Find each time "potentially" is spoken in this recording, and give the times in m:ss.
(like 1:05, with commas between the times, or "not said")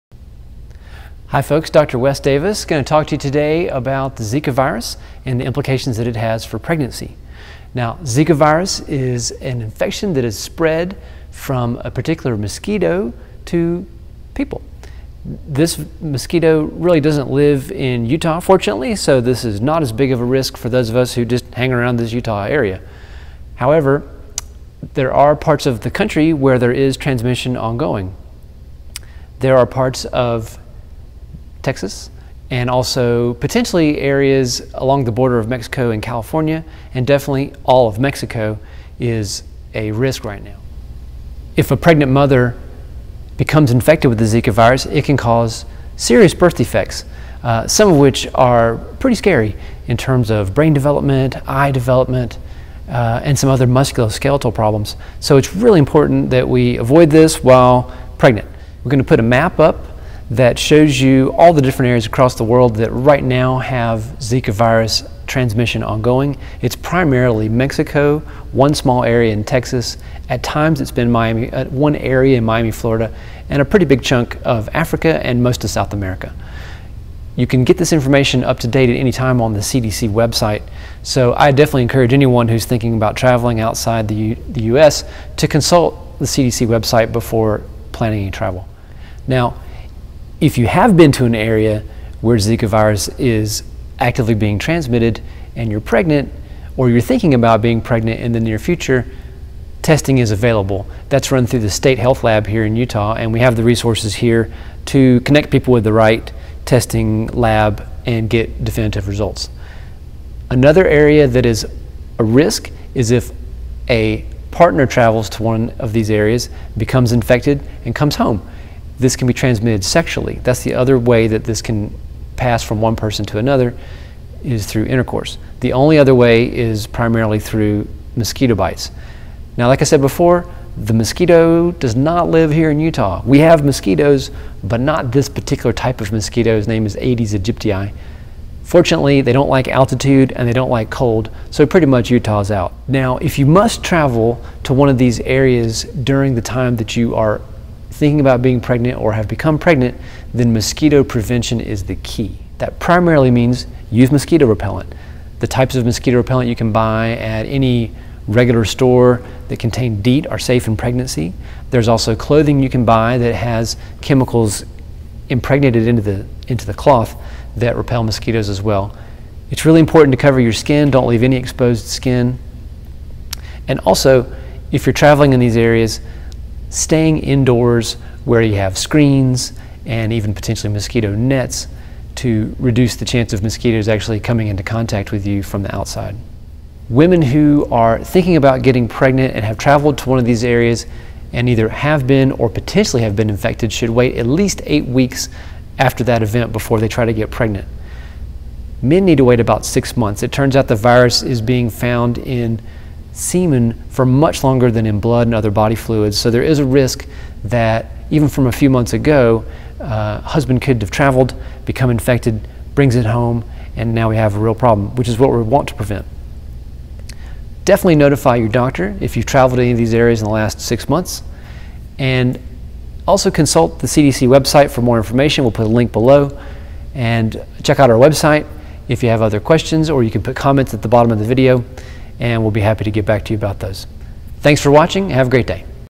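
0:33, 3:00, 3:12.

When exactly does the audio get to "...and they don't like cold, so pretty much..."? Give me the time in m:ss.
2:20.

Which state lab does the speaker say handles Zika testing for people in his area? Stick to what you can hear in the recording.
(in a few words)
State Health Lab.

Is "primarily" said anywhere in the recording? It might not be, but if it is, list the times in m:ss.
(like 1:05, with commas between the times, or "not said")
1:06, 2:06, 2:32.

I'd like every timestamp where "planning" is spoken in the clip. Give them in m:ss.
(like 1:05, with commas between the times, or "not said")
1:27.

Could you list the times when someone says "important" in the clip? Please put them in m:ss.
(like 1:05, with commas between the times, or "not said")
0:55, 2:49.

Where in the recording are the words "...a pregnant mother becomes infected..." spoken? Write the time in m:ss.
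0:41.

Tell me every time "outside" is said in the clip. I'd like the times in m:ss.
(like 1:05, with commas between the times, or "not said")
1:23, 3:05.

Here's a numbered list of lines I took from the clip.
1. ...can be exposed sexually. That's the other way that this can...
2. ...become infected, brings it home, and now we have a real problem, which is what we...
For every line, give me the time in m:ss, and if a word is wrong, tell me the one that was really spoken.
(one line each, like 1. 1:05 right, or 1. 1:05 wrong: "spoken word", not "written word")
1. 1:59 wrong: "transmitted", not "exposed"
2. 3:31 right.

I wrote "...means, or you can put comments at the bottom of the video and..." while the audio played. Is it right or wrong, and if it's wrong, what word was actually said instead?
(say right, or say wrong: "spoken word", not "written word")
wrong: "questions", not "means".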